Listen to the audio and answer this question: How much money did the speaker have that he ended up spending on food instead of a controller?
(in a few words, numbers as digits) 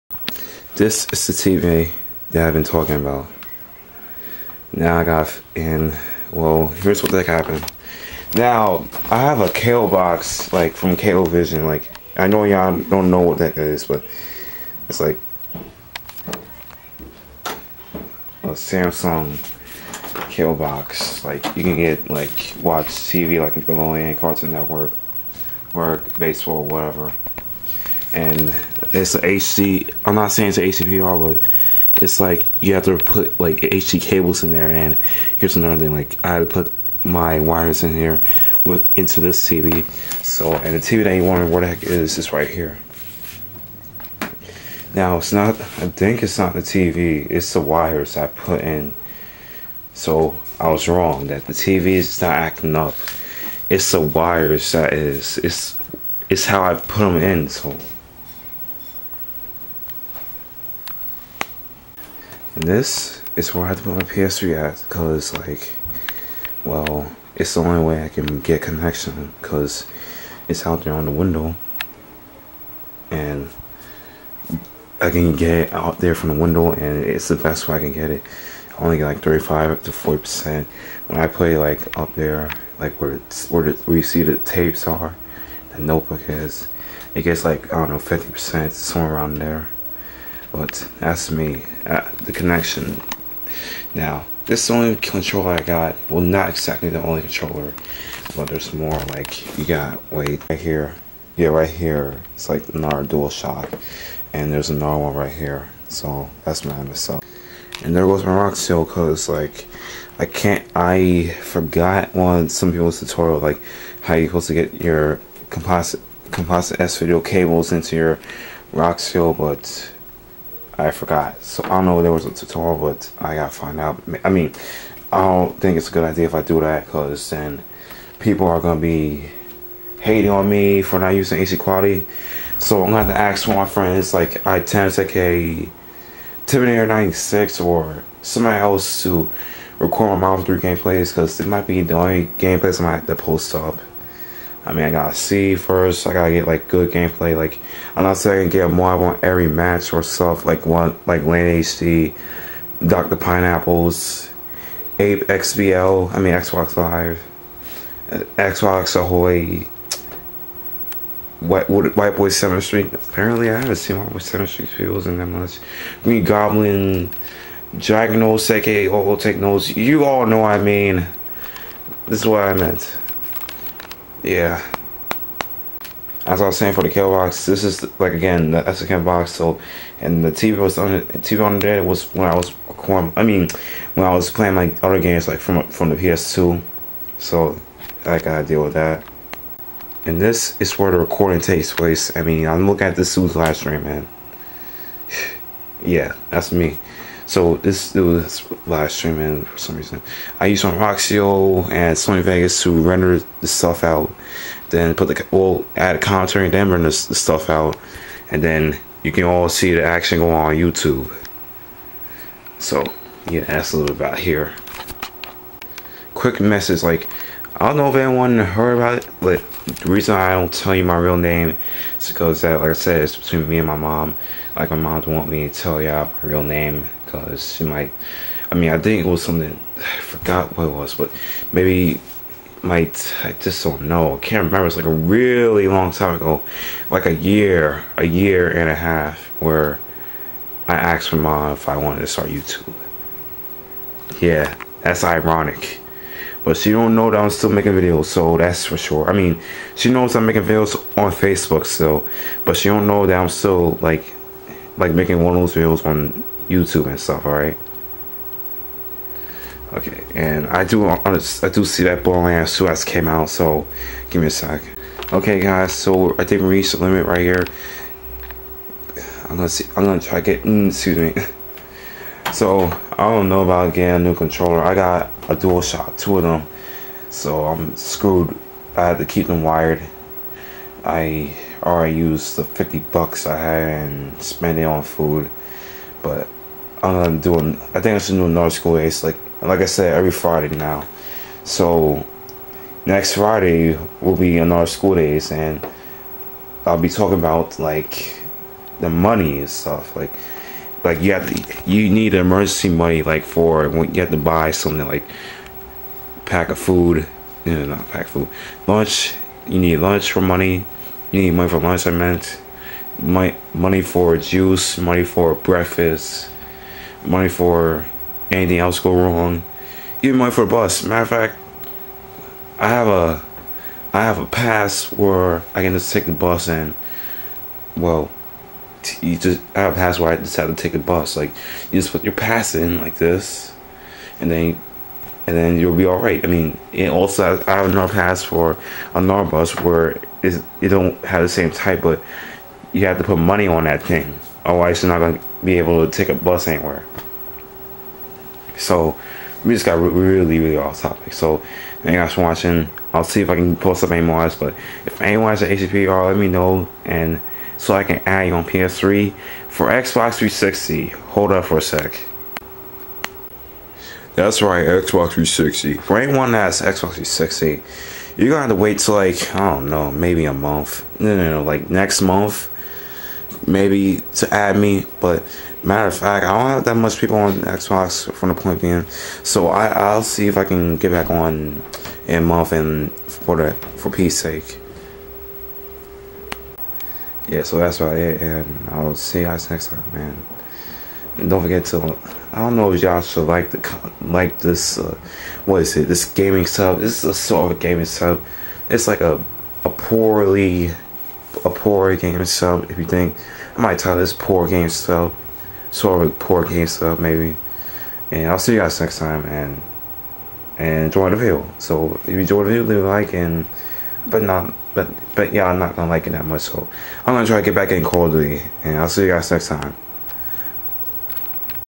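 $50.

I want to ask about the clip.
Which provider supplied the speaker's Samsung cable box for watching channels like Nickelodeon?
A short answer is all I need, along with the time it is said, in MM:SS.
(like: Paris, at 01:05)
Cablevision, at 00:10.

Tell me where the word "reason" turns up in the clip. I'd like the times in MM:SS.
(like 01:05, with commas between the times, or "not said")
03:19, 03:39.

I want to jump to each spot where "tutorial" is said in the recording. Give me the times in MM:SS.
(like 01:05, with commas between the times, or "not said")
01:52, 02:02.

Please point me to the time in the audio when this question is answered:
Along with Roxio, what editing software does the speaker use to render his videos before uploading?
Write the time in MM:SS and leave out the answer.
03:21.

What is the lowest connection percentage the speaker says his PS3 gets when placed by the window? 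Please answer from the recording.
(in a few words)
35.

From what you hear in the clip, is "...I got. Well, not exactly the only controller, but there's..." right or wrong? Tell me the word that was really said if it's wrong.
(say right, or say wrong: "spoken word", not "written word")
right.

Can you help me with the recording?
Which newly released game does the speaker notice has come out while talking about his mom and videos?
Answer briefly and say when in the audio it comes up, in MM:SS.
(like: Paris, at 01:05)
Borderlands 2, at 04:22.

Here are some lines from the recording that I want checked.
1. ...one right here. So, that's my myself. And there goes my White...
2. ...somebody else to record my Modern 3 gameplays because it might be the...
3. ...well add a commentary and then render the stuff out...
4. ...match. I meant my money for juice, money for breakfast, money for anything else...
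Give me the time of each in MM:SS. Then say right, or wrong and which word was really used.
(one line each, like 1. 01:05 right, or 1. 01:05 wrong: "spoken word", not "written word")
1. 01:45 wrong: "Roxio", not "White"
2. 02:18 right
3. 03:25 right
4. 05:11 wrong: "lunch", not "match".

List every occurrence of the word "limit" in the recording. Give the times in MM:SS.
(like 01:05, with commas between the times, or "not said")
04:26.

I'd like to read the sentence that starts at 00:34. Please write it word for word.
And here's another thing: like I had to put my wires in here with into this TV.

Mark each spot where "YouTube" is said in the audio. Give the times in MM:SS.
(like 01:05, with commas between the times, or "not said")
03:30, 04:02, 04:16.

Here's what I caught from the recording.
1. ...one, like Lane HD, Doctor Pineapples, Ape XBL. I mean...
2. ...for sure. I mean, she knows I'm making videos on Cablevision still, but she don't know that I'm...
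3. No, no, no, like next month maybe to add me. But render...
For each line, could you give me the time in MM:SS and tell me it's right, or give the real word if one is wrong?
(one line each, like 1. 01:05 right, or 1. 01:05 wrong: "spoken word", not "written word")
1. 02:30 right
2. 04:08 wrong: "Facebook", not "Cablevision"
3. 06:10 wrong: "matter", not "render".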